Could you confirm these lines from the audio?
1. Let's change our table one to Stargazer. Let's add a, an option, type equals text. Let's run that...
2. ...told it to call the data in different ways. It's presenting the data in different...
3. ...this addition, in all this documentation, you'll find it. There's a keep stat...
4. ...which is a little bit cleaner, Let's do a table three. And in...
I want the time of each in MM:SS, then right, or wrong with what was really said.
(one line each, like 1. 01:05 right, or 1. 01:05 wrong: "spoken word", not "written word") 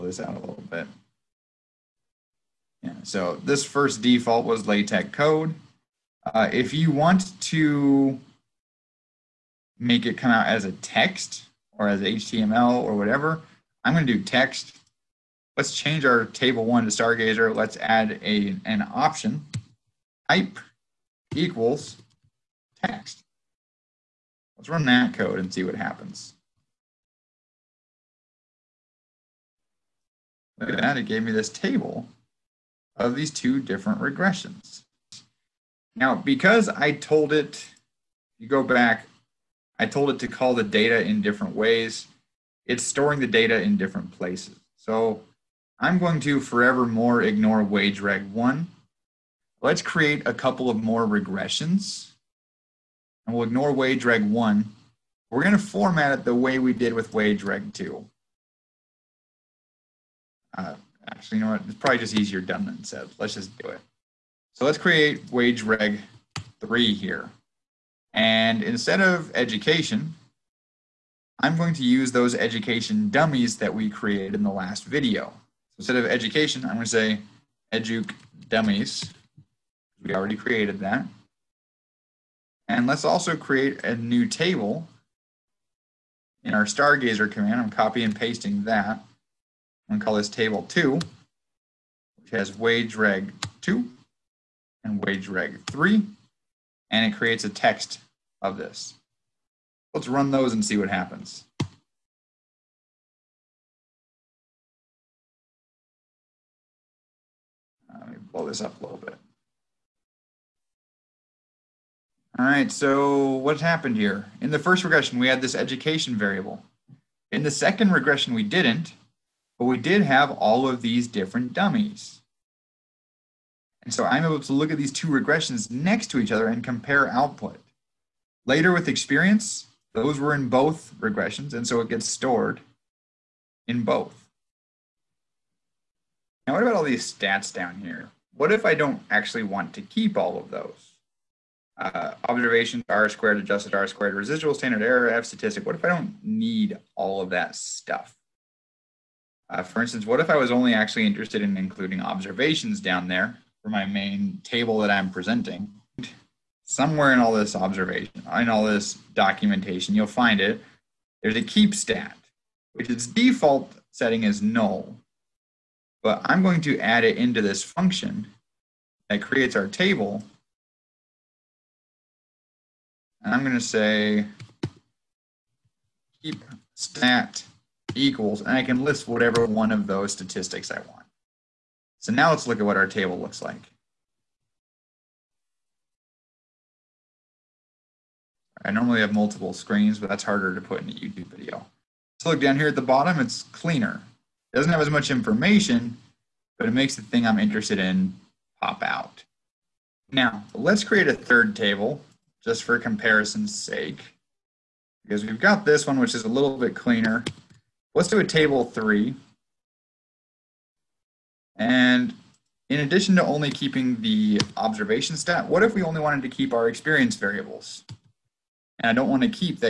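1. 00:15 right
2. 00:39 wrong: "storing", not "presenting"
3. 02:37 wrong: "observation", not "addition"
4. 03:25 right.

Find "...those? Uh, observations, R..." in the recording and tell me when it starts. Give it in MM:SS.
02:20.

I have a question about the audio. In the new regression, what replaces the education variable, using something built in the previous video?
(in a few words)
educ dummies.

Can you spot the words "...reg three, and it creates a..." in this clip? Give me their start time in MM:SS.
01:35.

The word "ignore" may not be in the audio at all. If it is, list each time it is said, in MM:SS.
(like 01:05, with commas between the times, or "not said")
00:47, 00:53.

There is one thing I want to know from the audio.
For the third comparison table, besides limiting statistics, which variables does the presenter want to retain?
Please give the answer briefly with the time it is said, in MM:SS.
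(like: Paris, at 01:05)
experience variables, at 03:36.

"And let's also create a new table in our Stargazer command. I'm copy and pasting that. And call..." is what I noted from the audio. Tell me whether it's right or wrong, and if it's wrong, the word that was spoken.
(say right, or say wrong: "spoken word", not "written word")
right.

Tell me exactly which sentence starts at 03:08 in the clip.
I normally have multiple screens, but that's harder to put in a YouTube video.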